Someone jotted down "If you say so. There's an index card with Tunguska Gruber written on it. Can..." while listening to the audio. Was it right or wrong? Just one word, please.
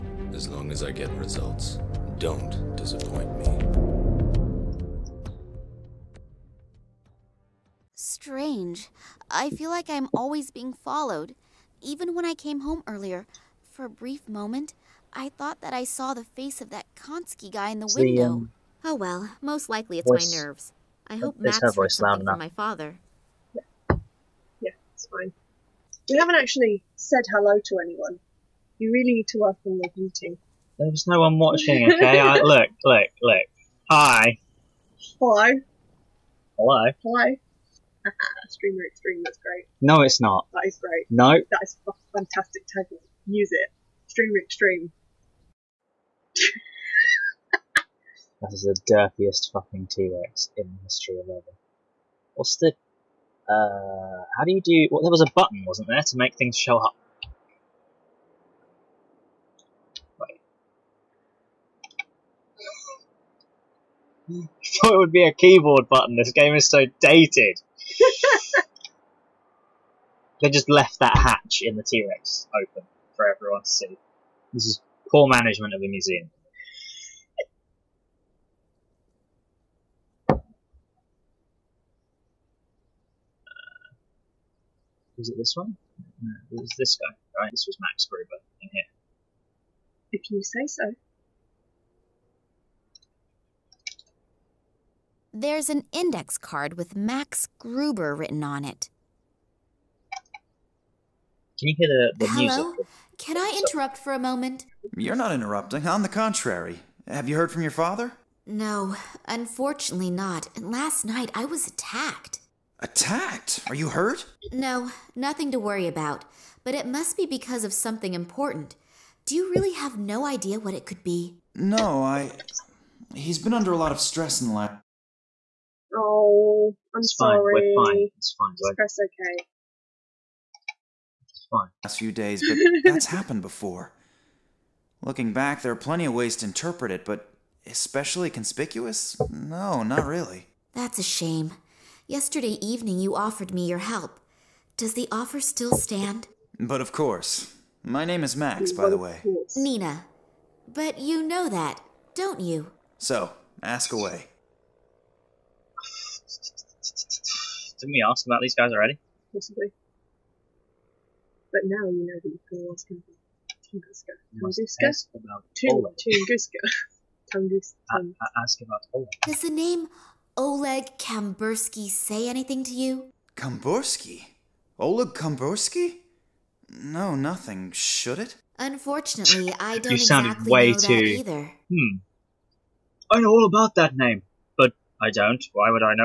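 wrong.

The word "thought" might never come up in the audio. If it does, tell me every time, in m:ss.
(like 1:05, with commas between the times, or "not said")
0:15, 1:04.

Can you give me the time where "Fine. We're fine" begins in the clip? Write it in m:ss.
2:07.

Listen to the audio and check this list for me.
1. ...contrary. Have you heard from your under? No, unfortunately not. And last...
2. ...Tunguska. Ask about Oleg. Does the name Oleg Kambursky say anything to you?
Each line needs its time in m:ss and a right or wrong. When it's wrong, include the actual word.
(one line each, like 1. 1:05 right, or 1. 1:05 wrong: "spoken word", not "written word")
1. 1:46 wrong: "father", not "under"
2. 2:47 right.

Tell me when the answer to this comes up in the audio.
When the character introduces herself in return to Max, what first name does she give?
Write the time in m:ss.
2:29.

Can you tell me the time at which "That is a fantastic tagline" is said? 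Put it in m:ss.
0:41.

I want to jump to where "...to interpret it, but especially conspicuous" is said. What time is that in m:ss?
2:16.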